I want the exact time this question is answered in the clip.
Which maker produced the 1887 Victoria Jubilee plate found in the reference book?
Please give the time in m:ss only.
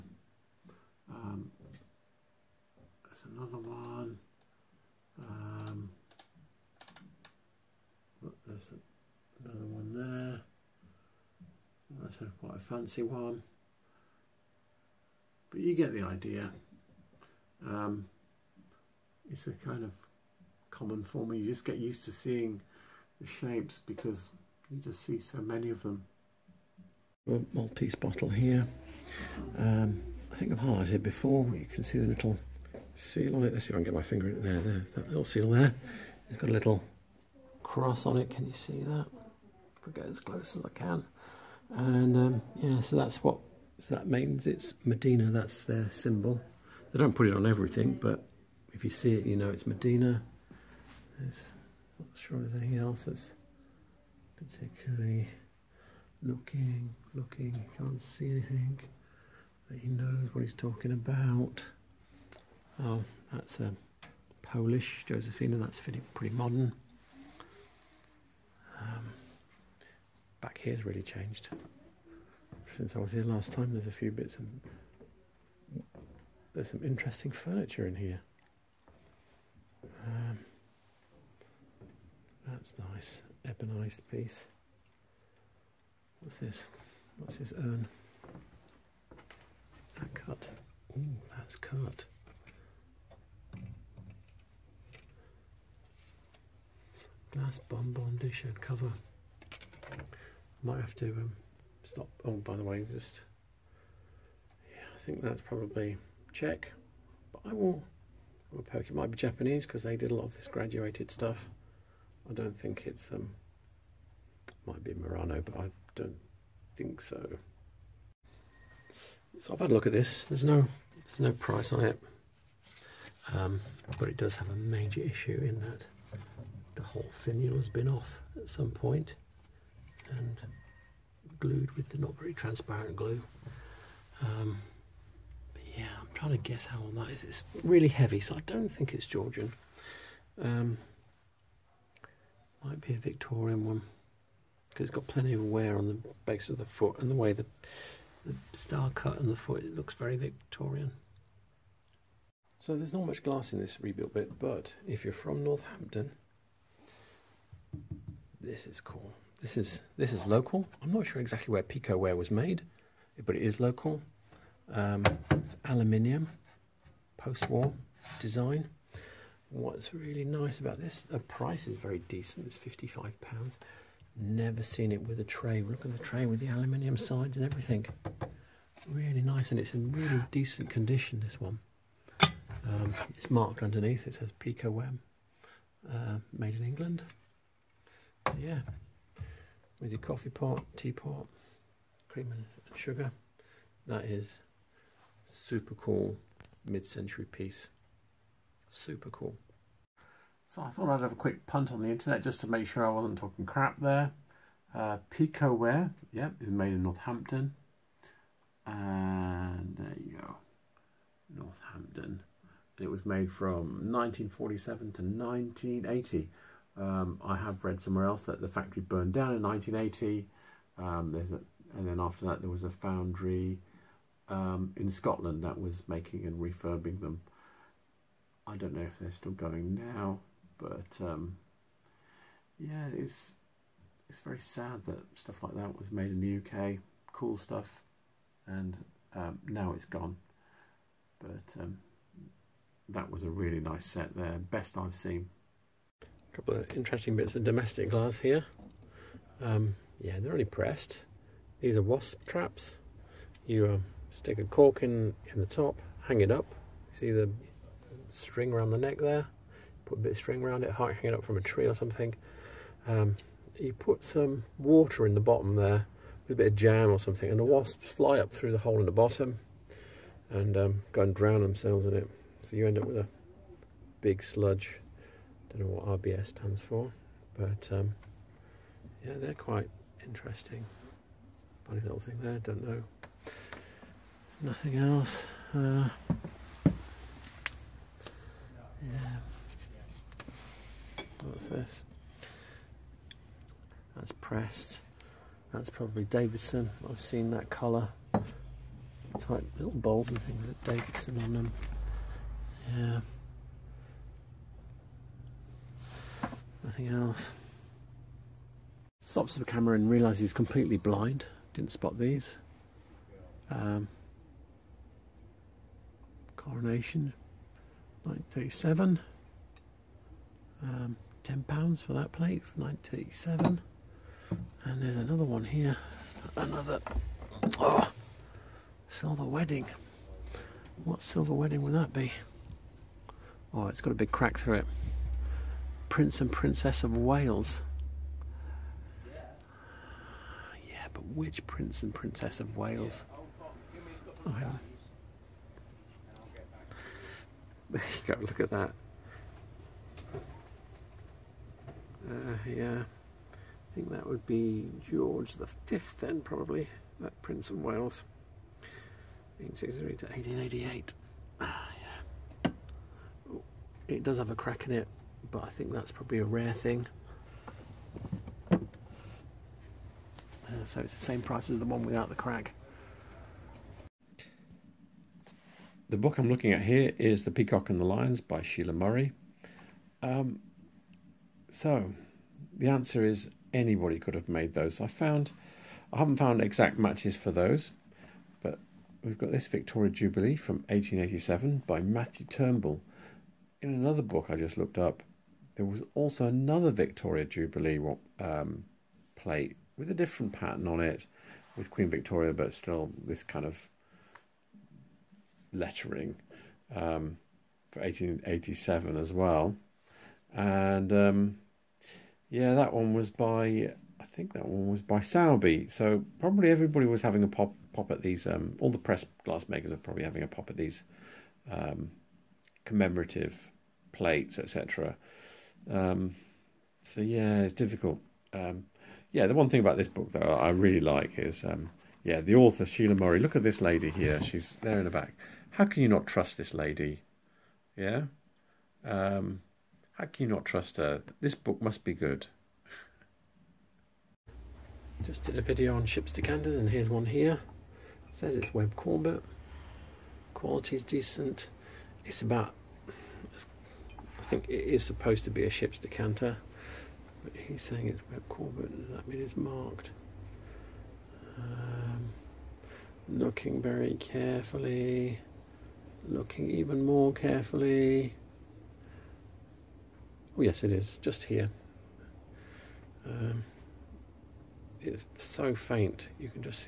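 6:31.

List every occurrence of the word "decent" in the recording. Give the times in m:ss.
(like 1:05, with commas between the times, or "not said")
2:51, 3:00, 7:30.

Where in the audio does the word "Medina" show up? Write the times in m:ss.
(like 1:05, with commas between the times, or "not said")
0:44, 0:49.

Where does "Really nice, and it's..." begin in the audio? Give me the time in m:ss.
2:58.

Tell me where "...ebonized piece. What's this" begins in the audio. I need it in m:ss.
1:23.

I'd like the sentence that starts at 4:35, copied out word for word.
Don't know what RBS stands for, but um, yeah, they're quite interesting.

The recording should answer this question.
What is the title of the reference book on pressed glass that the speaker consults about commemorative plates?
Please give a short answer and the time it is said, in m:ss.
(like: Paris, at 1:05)
The Peacock and the Lions, at 6:17.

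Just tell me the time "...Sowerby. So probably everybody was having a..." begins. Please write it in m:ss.
6:54.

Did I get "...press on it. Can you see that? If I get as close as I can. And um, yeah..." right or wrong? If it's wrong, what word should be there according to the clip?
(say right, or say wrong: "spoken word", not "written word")
wrong: "cross", not "press".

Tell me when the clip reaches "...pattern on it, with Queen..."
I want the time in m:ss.
6:40.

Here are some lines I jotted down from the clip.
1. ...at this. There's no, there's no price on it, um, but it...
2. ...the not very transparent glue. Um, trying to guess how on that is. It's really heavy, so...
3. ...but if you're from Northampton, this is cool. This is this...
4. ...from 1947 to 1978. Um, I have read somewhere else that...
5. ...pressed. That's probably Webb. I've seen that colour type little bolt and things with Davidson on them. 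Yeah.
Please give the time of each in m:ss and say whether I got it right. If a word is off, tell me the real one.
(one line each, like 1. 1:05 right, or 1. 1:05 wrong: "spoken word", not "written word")
1. 1:59 right
2. 2:11 right
3. 2:34 right
4. 3:33 wrong: "1980", not "1978"
5. 4:54 wrong: "Davidson", not "Webb".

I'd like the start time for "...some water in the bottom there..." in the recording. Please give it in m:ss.
4:24.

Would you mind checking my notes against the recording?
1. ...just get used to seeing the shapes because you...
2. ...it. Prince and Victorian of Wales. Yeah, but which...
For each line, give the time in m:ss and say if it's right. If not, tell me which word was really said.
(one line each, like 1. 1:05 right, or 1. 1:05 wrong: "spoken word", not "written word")
1. 0:21 right
2. 5:34 wrong: "Princess", not "Victorian".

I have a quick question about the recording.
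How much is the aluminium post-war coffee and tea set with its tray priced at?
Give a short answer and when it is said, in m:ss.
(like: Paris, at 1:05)
£55, at 2:52.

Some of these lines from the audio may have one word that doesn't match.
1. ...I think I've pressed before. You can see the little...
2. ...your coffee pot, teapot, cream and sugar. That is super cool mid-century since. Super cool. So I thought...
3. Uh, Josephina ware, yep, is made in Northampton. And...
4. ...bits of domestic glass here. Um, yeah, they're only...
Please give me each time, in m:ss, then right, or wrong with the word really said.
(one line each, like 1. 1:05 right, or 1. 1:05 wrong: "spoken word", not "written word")
1. 0:30 wrong: "highlighted", not "pressed"
2. 3:09 wrong: "piece", not "since"
3. 3:24 wrong: "Picquot", not "Josephina"
4. 4:07 right.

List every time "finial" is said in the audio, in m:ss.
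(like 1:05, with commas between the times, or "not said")
2:07.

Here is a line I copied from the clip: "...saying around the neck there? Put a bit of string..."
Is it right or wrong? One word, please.
wrong.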